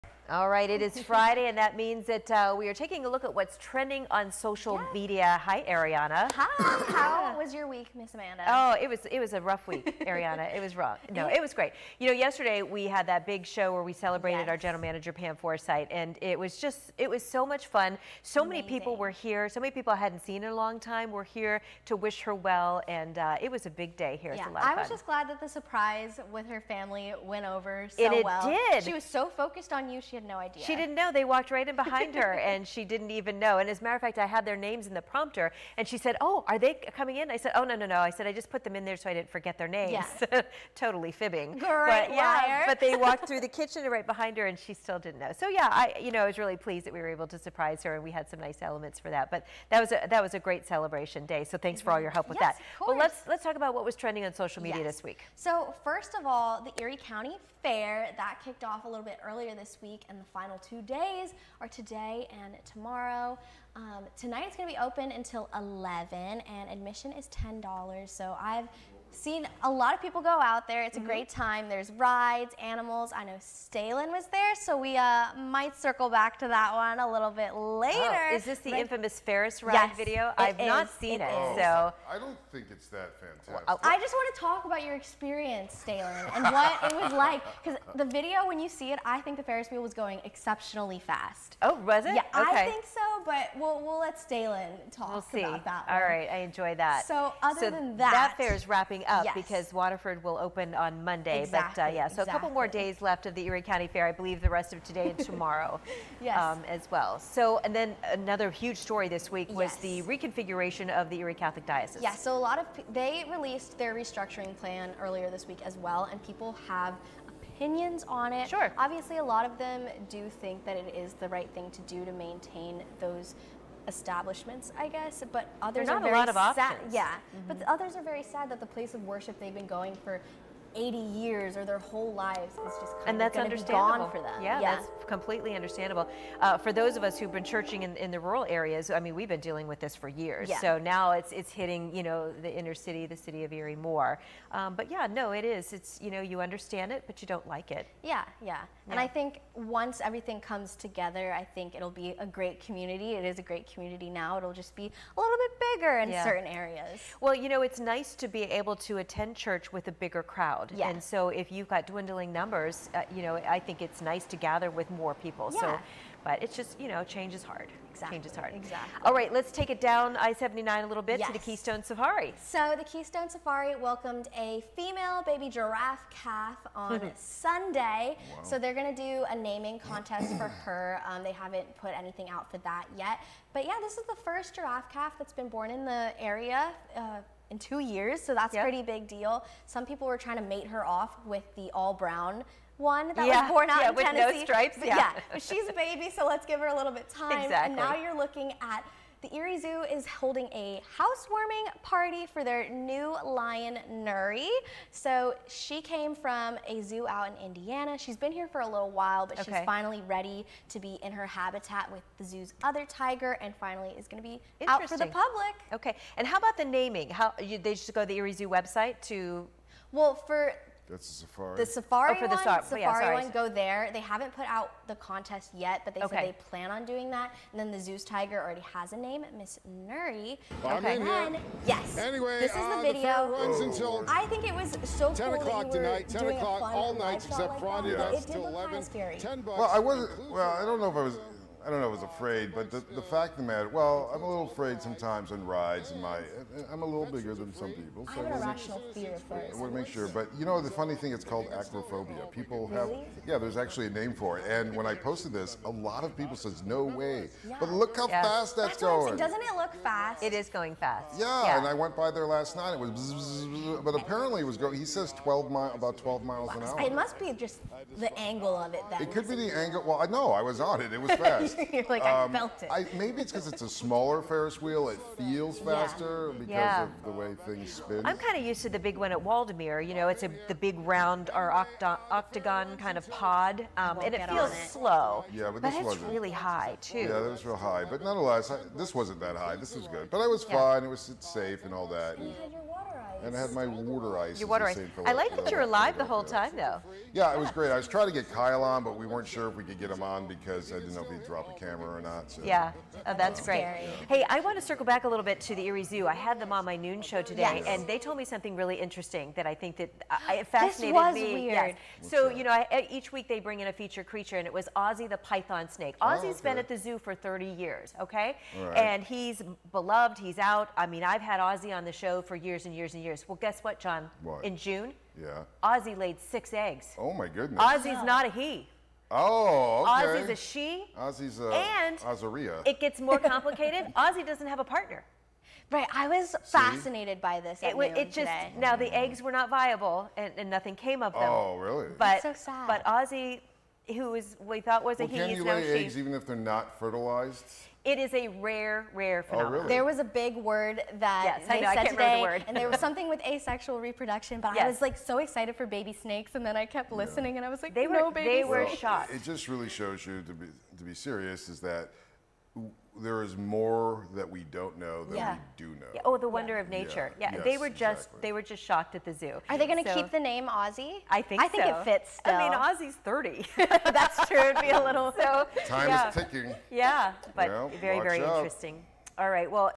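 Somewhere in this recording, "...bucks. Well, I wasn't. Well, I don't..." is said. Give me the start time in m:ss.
3:59.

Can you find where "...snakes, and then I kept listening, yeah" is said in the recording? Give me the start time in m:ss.
5:55.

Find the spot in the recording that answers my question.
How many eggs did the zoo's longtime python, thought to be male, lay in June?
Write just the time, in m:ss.
5:26.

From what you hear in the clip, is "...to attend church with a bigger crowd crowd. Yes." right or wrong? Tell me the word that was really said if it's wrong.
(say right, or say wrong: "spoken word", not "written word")
right.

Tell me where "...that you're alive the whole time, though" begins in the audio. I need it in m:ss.
4:55.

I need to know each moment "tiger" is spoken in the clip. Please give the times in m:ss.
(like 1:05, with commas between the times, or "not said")
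3:32, 3:48.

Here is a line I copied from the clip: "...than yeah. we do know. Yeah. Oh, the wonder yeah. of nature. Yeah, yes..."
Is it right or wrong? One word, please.
right.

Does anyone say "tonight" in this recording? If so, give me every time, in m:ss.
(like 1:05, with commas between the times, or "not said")
1:04, 3:55.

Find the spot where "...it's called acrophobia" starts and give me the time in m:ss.
4:11.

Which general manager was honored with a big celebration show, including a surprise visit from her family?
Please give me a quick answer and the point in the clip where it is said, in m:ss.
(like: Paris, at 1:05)
Pam Forsythe, at 0:15.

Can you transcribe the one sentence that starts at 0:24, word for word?
Yeah, I was just glad that the surprise with her family went over so it well.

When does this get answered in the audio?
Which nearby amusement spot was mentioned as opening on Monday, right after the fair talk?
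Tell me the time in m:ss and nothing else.
1:39.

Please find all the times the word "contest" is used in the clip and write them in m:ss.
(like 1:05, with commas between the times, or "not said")
2:59, 3:44.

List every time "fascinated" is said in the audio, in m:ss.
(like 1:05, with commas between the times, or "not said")
5:10, 5:36.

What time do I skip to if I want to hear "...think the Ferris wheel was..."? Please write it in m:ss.
1:29.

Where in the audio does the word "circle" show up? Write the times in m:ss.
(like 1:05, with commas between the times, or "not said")
1:15, 5:04.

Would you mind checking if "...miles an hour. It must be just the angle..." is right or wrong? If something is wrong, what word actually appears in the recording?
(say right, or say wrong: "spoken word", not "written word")
right.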